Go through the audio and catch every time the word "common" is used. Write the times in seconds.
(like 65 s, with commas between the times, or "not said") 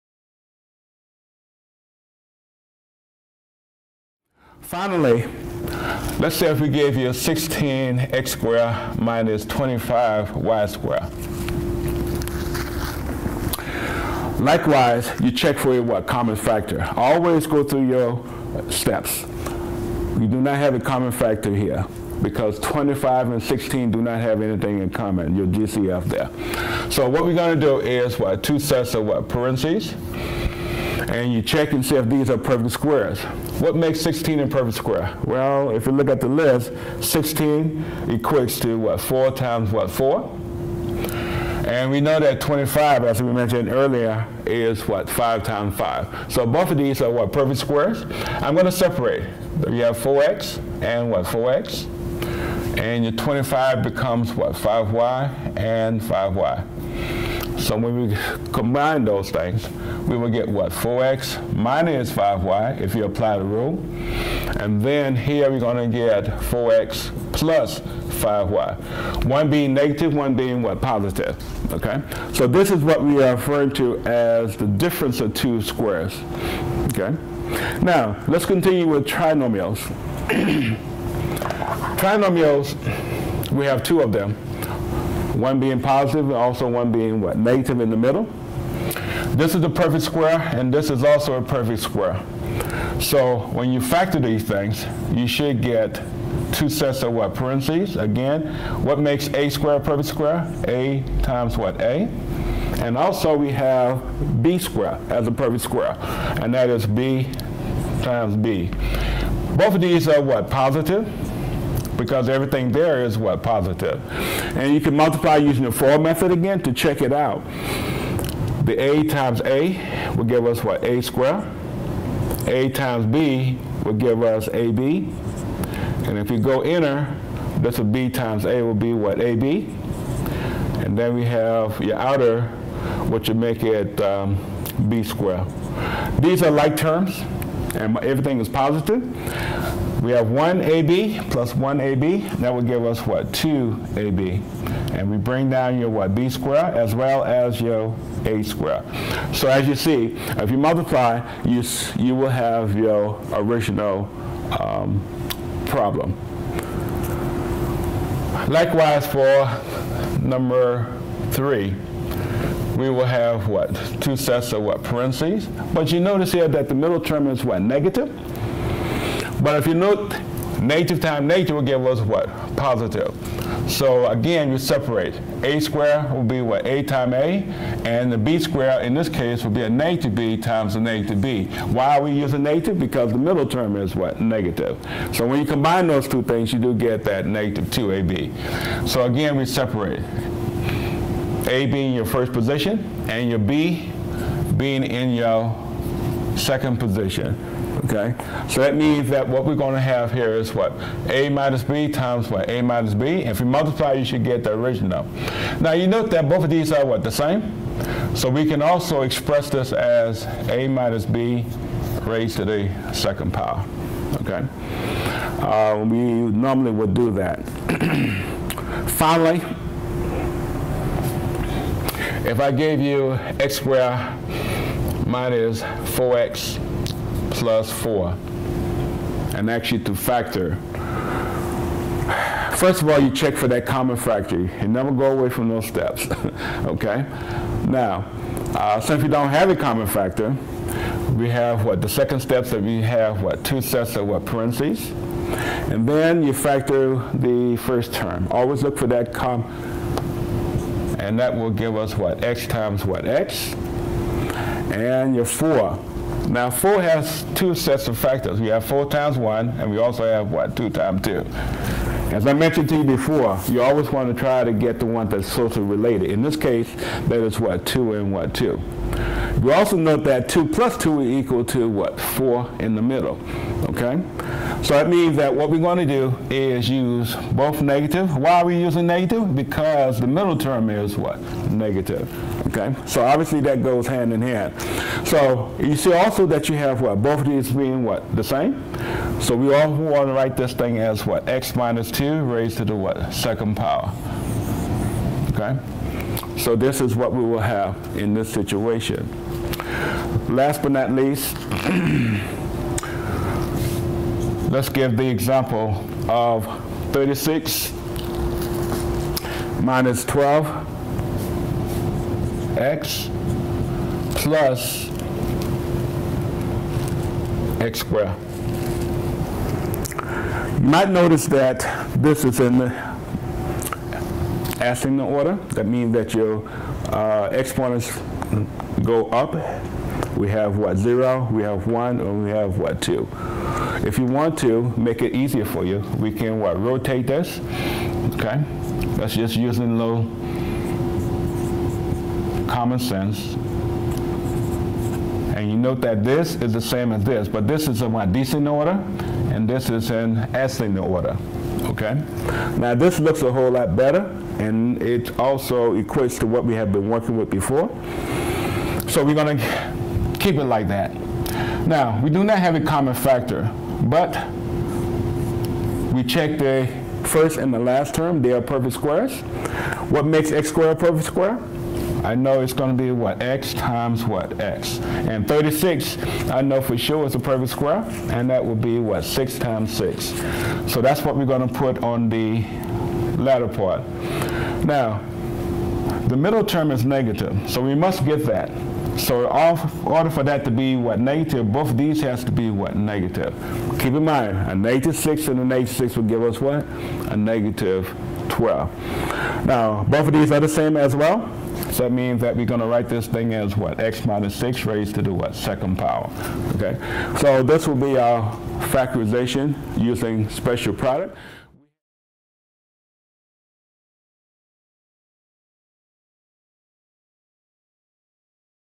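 16 s, 20 s, 24 s, 233 s, 239 s, 342 s, 362 s.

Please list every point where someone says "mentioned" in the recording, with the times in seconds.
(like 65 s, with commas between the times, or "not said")
43 s, 262 s.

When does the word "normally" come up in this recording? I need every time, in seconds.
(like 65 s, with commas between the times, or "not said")
215 s.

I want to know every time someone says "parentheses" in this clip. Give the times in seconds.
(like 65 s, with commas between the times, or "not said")
29 s, 97 s, 164 s, 244 s.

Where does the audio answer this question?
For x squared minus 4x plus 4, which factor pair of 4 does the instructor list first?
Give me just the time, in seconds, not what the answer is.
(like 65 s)
258 s.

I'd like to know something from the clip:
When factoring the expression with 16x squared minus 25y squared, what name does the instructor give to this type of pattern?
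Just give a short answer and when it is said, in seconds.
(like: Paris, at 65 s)
difference of two squares, at 74 s.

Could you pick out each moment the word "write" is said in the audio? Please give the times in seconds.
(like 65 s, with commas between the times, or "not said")
290 s, 402 s.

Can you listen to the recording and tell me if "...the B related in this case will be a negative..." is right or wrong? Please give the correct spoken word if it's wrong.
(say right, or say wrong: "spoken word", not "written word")
wrong: "squared", not "related".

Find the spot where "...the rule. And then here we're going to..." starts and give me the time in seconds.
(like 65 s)
63 s.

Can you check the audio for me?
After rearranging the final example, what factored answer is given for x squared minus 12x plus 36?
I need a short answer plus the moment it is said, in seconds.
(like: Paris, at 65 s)
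x minus 6 squared, at 403 s.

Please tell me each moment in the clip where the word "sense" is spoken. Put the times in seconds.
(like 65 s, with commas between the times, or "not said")
342 s.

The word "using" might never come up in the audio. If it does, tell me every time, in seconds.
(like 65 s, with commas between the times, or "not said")
115 s, 182 s, 278 s, 339 s, 409 s.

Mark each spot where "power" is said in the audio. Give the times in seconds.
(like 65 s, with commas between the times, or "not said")
213 s, 293 s, 405 s.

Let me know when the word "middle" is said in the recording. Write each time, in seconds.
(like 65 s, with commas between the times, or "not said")
87 s, 166 s, 183 s, 272 s, 280 s, 386 s.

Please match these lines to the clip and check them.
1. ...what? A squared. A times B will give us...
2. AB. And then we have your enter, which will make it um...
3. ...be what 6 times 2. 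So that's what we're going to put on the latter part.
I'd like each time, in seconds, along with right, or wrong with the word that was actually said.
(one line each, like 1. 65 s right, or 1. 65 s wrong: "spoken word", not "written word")
1. 120 s right
2. 129 s wrong: "outer", not "enter"
3. 378 s wrong: "6", not "2".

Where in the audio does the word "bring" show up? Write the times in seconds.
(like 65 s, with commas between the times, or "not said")
145 s.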